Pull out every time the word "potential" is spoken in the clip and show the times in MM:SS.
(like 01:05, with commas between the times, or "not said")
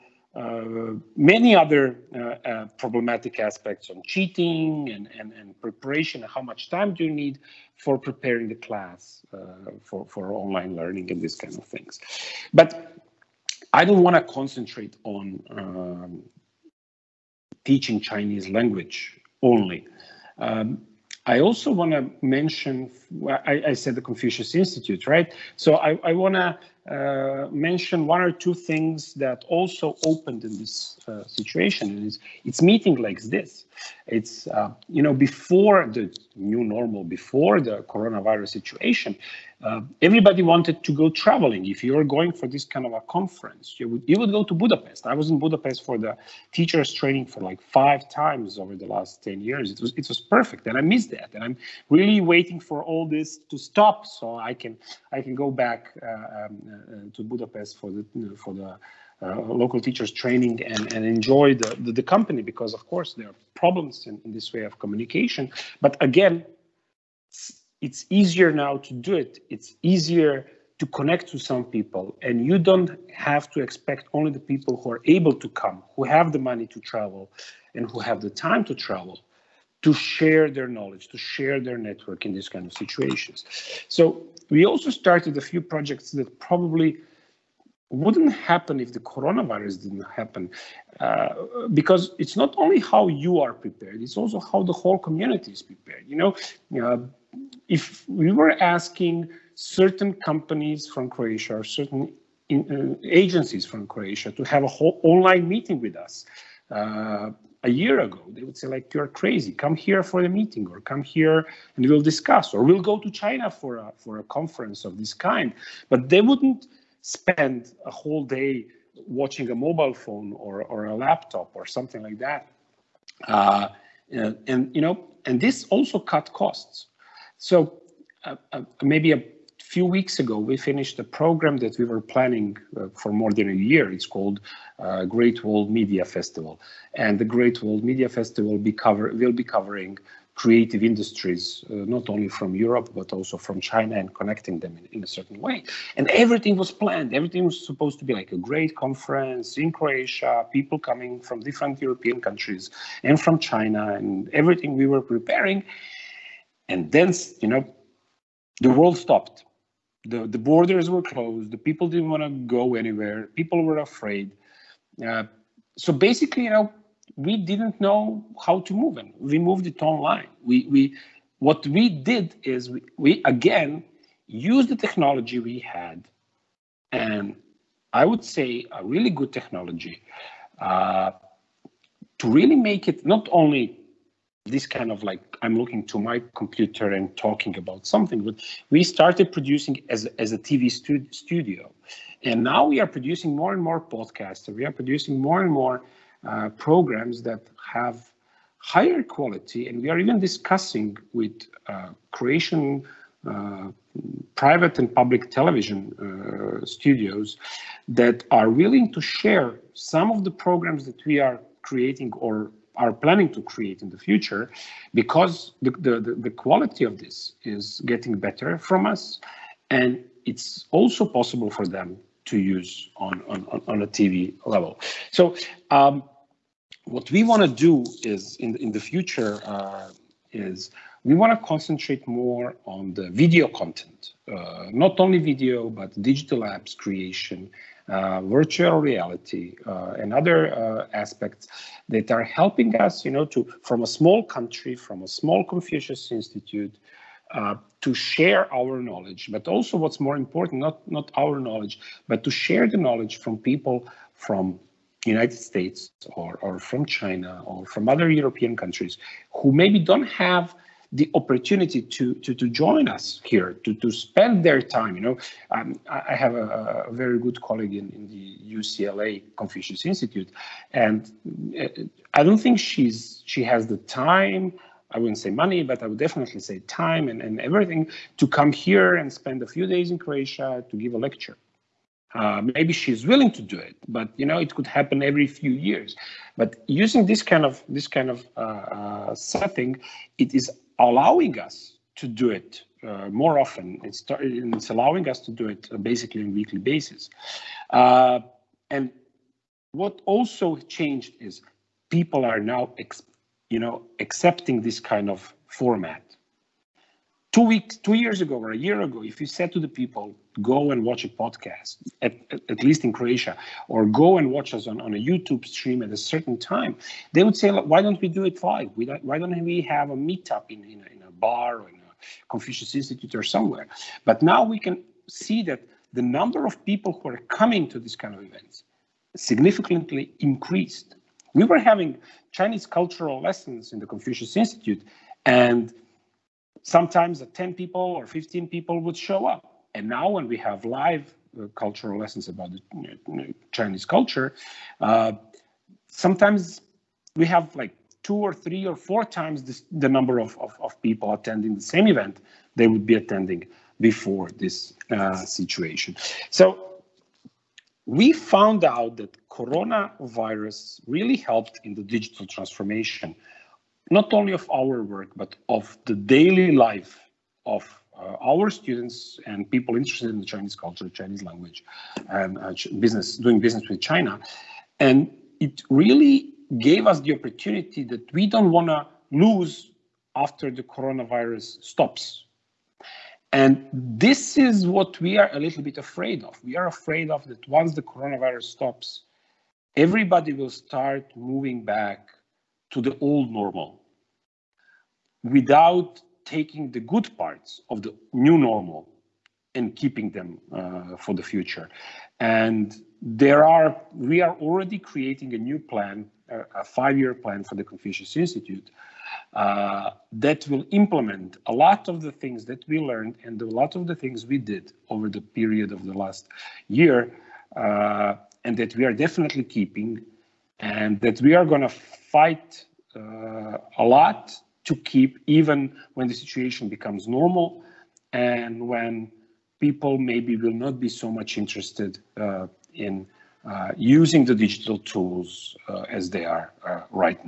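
not said.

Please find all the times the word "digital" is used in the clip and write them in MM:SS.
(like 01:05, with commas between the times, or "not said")
03:56, 06:01, 07:14.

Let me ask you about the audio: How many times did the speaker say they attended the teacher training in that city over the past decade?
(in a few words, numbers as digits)
5.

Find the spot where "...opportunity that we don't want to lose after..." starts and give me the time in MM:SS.
06:17.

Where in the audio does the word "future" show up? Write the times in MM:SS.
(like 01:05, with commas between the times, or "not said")
03:33, 03:48, 06:41.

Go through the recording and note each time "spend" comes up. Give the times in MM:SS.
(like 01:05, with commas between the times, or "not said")
01:57, 04:23, 04:39.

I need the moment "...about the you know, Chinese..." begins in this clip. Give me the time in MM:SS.
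05:42.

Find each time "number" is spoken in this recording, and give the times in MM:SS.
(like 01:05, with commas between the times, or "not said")
05:26, 05:49.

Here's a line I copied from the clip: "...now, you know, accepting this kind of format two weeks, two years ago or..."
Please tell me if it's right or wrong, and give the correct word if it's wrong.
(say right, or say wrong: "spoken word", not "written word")
right.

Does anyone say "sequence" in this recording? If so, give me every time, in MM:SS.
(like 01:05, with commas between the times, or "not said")
not said.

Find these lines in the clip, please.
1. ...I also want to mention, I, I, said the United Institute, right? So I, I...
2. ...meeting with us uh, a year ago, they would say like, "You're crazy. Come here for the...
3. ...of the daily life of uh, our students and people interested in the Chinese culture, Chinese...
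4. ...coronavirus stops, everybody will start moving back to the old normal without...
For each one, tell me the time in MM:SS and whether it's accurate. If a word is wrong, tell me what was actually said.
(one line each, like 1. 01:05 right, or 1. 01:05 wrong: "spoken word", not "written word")
1. 00:21 wrong: "Confucius", not "United"
2. 01:45 right
3. 06:05 right
4. 06:27 right.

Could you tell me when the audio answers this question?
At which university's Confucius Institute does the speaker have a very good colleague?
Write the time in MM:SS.
04:28.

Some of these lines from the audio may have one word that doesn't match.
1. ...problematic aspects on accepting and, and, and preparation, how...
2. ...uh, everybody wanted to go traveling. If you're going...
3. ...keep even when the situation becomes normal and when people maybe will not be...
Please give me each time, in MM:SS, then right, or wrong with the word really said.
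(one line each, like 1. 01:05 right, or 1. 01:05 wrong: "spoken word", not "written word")
1. 00:02 wrong: "cheating", not "accepting"
2. 00:39 right
3. 07:04 right.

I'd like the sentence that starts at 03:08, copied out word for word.
But we started producing as as a TV stu- studio, and now we are producing more and more podcasts.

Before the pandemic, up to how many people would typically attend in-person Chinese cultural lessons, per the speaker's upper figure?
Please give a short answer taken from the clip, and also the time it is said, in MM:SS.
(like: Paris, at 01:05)
15, at 05:38.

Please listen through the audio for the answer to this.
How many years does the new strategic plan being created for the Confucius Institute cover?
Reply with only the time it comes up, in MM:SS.
06:46.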